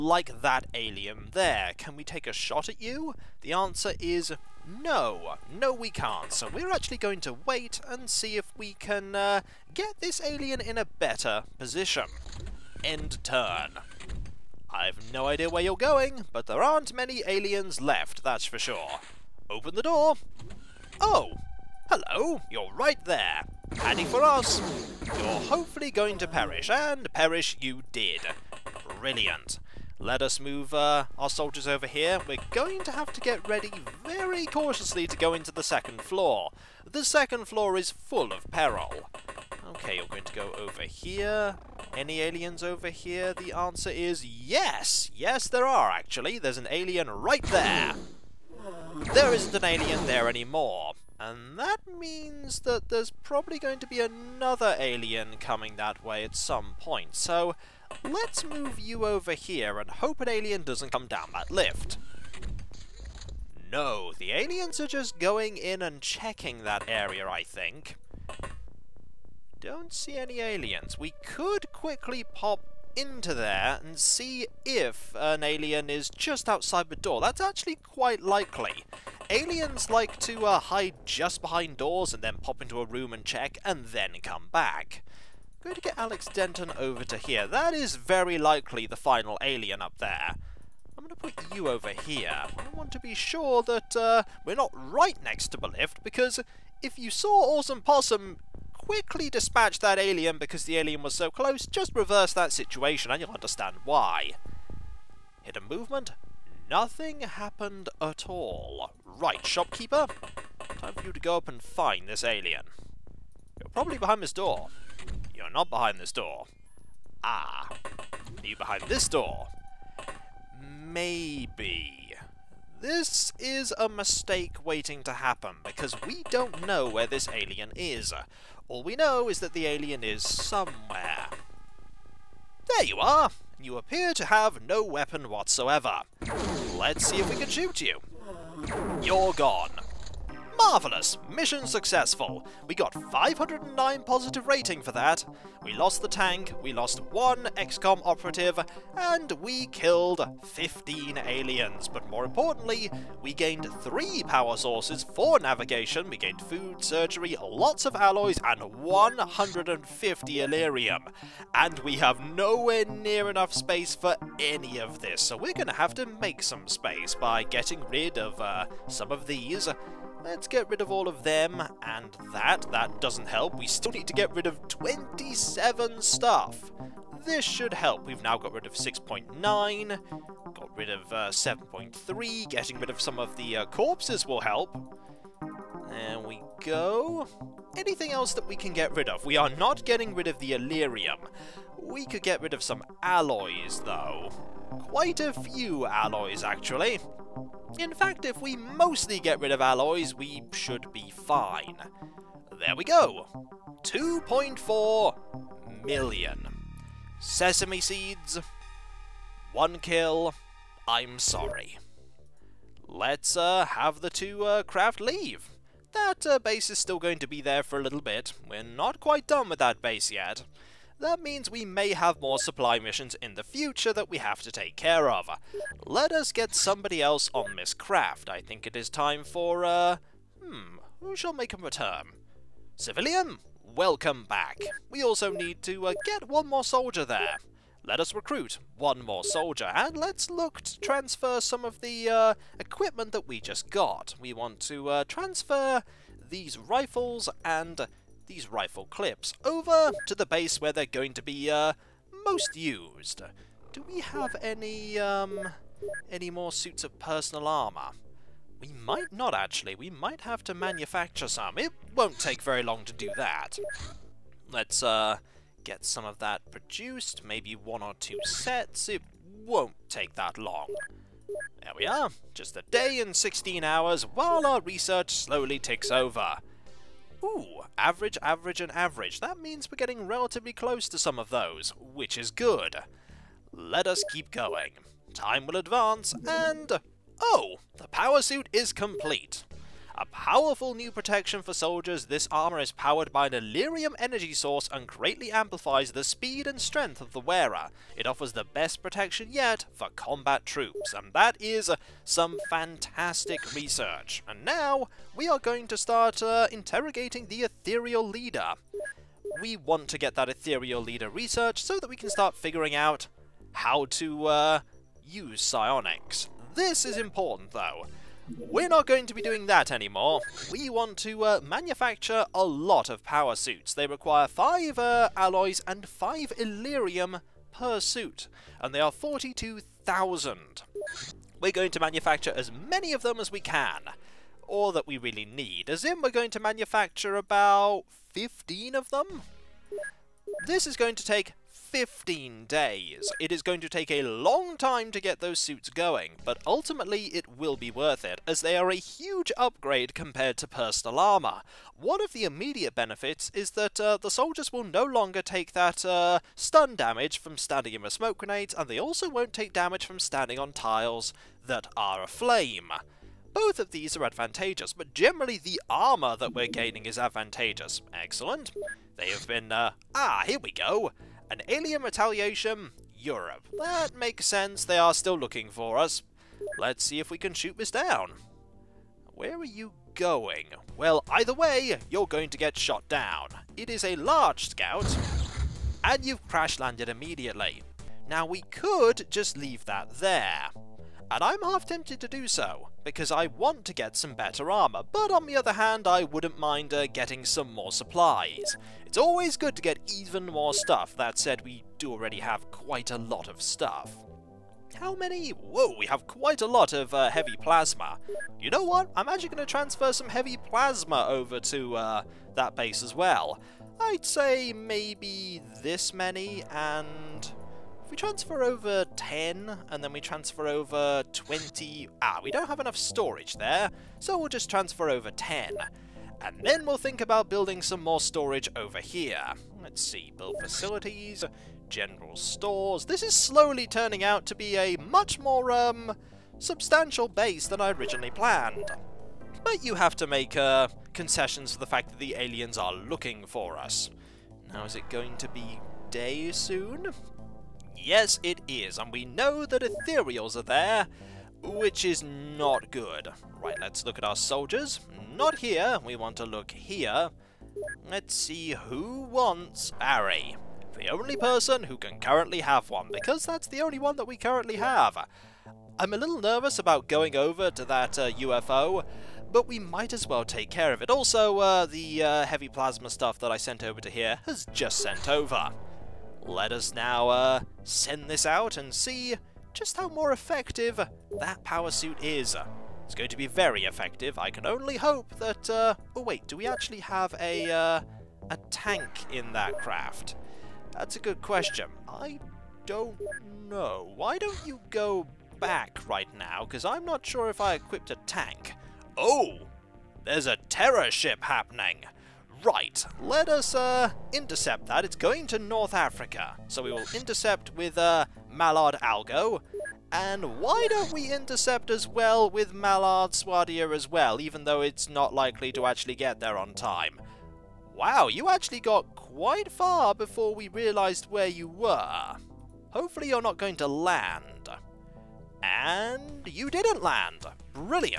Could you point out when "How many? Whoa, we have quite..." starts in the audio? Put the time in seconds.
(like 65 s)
404 s.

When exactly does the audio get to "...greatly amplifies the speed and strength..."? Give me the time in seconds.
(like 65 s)
294 s.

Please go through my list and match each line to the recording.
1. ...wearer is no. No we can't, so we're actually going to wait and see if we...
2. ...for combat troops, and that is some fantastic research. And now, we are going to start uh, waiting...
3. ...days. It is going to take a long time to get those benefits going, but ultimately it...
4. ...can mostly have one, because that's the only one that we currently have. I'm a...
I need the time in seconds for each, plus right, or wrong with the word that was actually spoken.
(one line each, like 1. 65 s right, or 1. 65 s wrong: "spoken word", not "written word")
1. 3 s wrong: "answer", not "wearer"
2. 299 s wrong: "interrogating", not "waiting"
3. 342 s wrong: "suits", not "benefits"
4. 461 s wrong: "currently", not "mostly".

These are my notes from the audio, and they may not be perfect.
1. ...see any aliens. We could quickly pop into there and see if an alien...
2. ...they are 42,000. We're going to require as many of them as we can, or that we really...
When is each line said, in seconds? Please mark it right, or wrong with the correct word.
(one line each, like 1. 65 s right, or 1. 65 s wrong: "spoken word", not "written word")
1. 69 s right
2. 328 s wrong: "manufacture", not "require".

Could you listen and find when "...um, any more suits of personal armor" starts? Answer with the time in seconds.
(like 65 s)
254 s.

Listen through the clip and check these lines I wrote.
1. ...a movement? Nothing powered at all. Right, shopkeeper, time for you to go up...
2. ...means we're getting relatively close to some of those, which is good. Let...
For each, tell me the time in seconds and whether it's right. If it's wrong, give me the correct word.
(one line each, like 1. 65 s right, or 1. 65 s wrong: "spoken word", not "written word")
1. 105 s wrong: "happened", not "powered"
2. 279 s right.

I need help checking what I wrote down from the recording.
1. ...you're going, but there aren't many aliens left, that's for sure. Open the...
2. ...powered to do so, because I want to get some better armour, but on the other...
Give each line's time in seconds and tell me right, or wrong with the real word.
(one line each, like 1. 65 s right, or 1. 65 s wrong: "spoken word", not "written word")
1. 15 s right
2. 391 s wrong: "tempted", not "powered".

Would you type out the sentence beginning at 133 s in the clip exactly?
You appear to have no weapon whatsoever.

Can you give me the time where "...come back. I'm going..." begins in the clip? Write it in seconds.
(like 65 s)
84 s.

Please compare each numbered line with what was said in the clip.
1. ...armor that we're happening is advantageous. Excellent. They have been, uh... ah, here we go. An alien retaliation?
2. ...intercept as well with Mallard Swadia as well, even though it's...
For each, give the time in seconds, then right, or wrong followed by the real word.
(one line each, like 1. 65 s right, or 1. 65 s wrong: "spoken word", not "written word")
1. 365 s wrong: "gaining", not "happening"
2. 511 s right.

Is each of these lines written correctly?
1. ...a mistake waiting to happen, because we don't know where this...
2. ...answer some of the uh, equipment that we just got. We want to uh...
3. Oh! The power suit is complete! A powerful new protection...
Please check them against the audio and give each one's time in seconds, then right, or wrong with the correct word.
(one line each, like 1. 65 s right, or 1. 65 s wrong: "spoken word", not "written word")
1. 123 s right
2. 240 s wrong: "transfer", not "answer"
3. 287 s right.